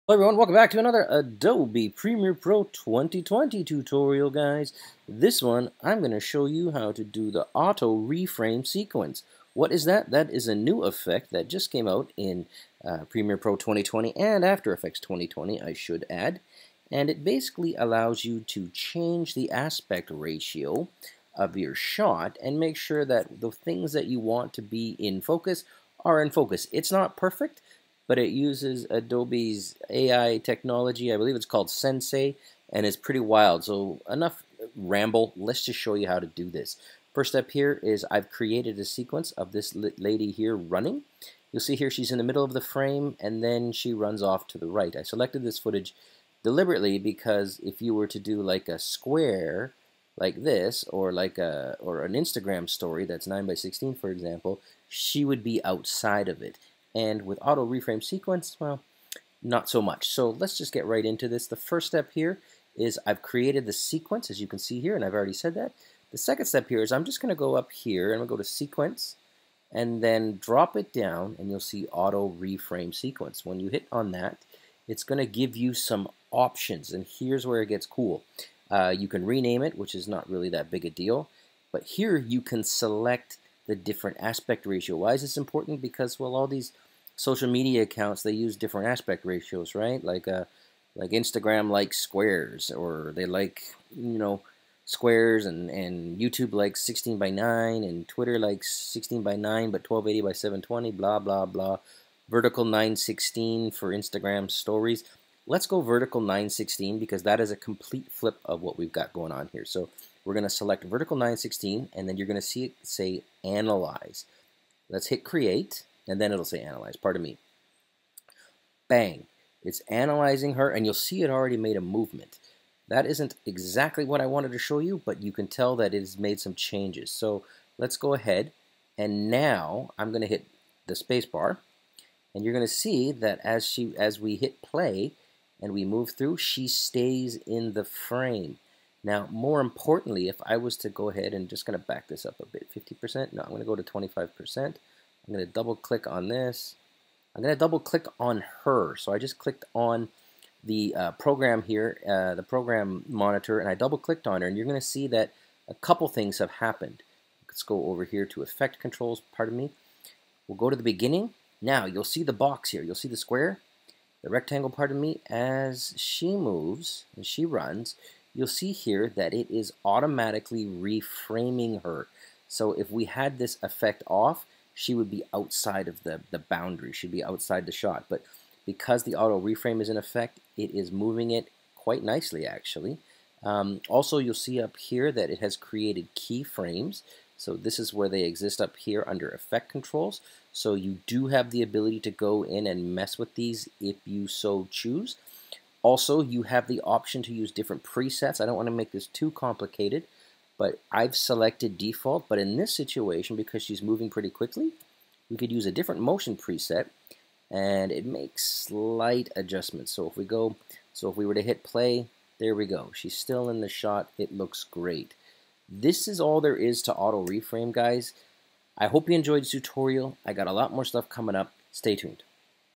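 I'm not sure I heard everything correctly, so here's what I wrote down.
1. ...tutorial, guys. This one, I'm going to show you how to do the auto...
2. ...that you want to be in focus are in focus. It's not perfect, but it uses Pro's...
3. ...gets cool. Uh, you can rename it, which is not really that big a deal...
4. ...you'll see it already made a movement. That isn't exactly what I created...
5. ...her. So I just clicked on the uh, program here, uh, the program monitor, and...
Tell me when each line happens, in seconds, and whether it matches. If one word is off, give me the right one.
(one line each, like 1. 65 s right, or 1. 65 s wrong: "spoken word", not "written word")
1. 3 s right
2. 23 s wrong: "Adobe", not "Pro"
3. 77 s right
4. 120 s wrong: "wanted", not "created"
5. 148 s right.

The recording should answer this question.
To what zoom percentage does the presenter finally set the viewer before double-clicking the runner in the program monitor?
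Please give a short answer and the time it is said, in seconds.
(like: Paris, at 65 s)
25%, at 143 s.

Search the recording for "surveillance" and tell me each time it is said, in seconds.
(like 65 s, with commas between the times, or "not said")
not said.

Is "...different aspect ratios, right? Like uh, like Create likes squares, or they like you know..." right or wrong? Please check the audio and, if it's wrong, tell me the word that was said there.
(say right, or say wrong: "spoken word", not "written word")
wrong: "Instagram", not "Create".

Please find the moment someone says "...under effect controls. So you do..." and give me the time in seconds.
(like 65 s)
189 s.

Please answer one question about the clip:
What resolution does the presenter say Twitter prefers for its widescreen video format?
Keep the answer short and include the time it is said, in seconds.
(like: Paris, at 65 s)
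1280 by 720, at 99 s.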